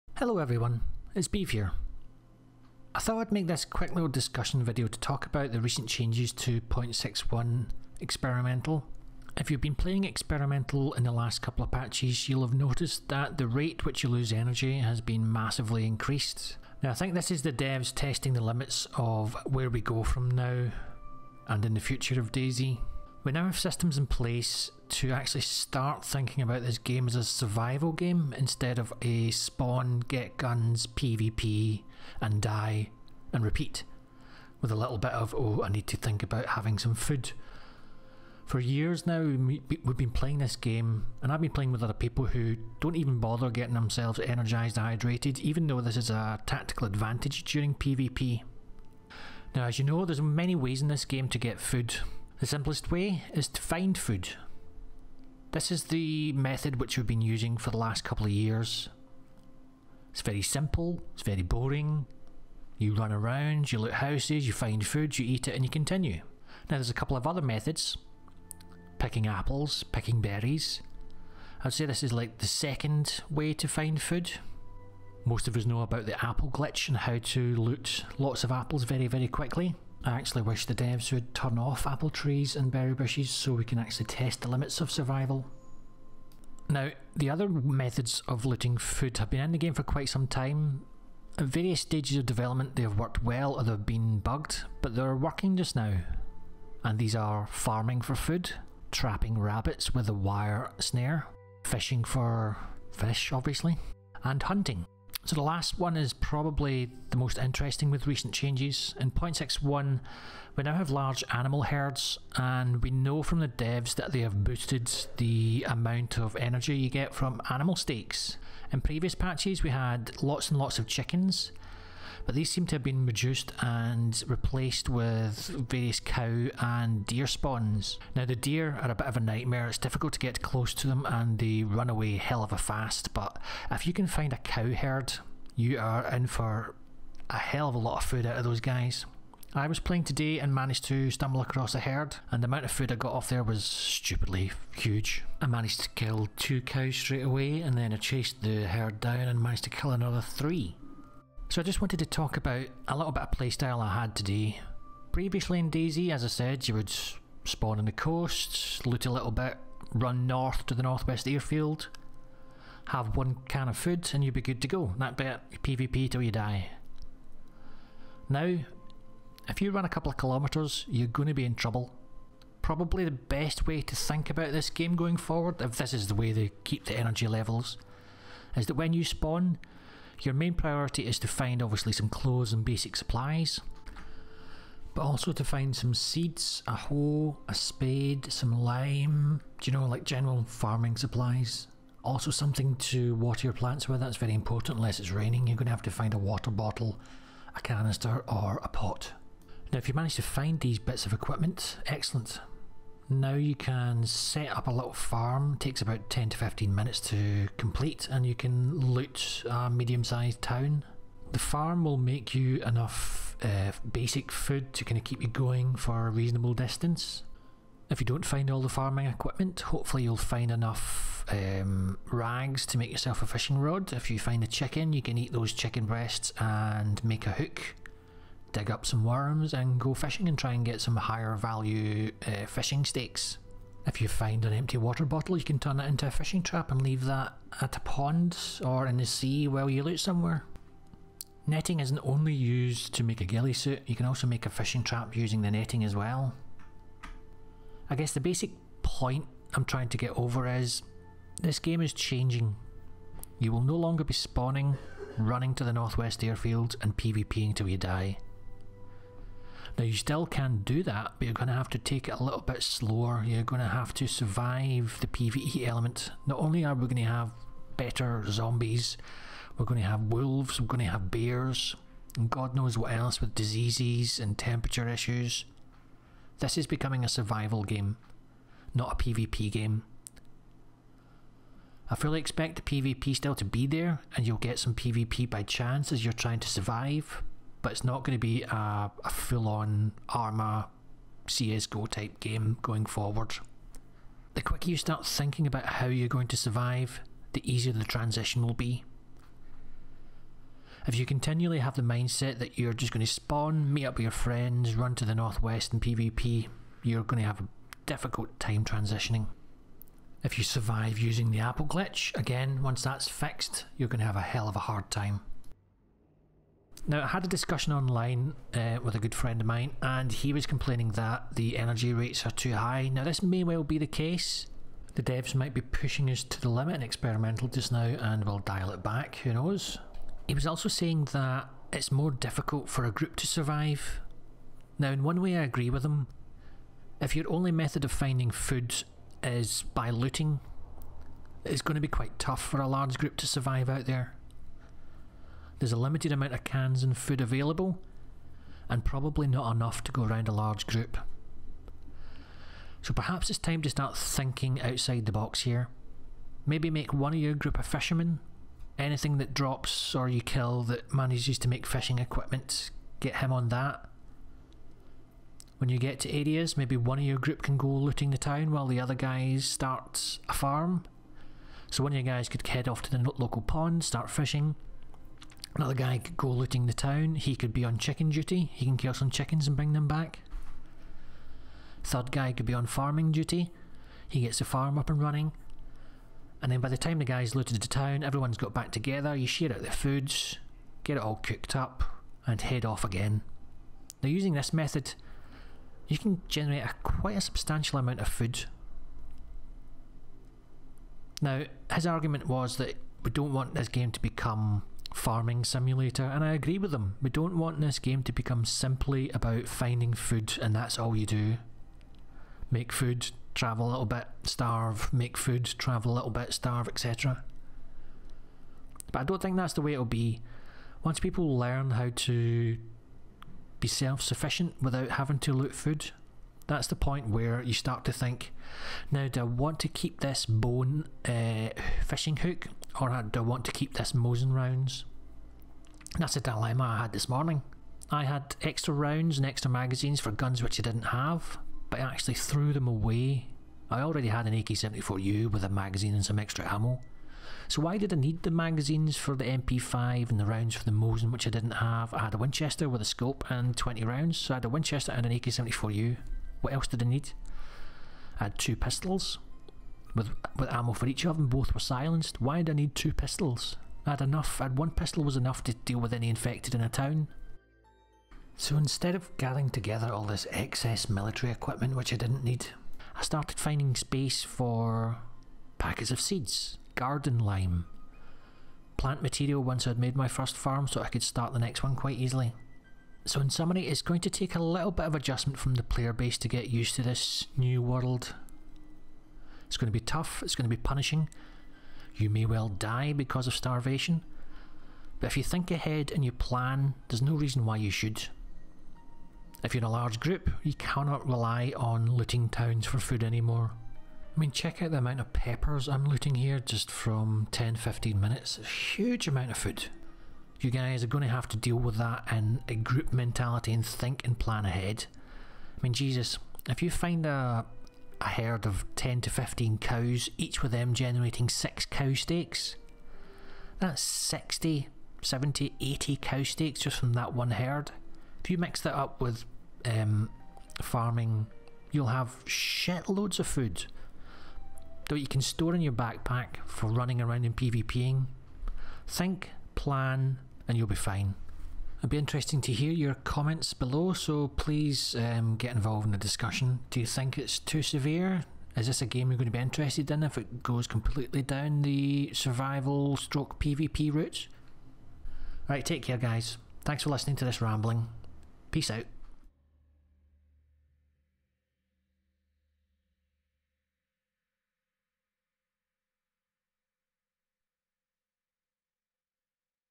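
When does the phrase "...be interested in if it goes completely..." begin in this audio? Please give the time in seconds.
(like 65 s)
549 s.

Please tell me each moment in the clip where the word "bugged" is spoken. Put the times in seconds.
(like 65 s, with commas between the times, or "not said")
94 s.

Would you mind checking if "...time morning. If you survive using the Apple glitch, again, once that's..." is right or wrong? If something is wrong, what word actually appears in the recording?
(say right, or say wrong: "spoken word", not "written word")
wrong: "transitioning", not "morning".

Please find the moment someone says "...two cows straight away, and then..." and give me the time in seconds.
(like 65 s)
146 s.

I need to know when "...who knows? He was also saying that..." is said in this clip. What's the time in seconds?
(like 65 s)
329 s.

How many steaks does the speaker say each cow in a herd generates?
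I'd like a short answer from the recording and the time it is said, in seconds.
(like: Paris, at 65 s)
6, at 521 s.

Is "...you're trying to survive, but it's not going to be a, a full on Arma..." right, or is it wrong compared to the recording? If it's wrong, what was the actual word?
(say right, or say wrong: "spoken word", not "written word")
right.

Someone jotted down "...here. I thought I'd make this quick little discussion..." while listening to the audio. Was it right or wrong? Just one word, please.
right.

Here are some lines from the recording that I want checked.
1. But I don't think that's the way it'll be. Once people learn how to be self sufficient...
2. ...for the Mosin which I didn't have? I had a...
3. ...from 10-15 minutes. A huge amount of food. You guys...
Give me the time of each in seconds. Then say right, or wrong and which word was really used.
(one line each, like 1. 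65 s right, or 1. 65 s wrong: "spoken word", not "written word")
1. 418 s right
2. 450 s right
3. 506 s right.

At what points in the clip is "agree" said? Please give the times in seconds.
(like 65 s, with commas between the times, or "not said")
335 s, 406 s.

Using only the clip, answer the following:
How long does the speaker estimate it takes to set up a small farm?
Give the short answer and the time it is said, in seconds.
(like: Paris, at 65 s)
10 to 15 minutes, at 206 s.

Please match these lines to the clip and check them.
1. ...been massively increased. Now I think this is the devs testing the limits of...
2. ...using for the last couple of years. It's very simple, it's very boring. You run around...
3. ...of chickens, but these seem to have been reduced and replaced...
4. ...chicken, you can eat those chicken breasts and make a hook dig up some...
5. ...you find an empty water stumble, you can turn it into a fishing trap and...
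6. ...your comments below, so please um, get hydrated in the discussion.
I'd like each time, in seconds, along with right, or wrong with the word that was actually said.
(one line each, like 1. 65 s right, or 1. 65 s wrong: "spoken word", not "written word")
1. 15 s right
2. 57 s right
3. 120 s right
4. 224 s right
5. 233 s wrong: "bottle", not "stumble"
6. 542 s wrong: "involved", not "hydrated".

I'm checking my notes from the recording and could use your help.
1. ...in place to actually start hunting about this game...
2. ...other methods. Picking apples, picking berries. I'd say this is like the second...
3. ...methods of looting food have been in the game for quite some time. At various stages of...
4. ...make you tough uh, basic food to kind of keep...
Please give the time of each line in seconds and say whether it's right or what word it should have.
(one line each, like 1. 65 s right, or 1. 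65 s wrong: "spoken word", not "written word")
1. 23 s wrong: "thinking", not "hunting"
2. 67 s right
3. 87 s right
4. 211 s wrong: "enough", not "tough".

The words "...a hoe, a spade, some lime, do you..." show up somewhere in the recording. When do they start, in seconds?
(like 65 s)
186 s.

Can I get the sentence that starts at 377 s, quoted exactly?
He could be on chicken duty.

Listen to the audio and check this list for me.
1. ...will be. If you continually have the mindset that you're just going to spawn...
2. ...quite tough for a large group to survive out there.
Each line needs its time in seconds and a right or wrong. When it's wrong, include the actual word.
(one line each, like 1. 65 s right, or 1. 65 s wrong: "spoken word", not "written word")
1. 298 s right
2. 341 s right.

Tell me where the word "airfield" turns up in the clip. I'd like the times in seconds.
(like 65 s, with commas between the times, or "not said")
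161 s, 256 s.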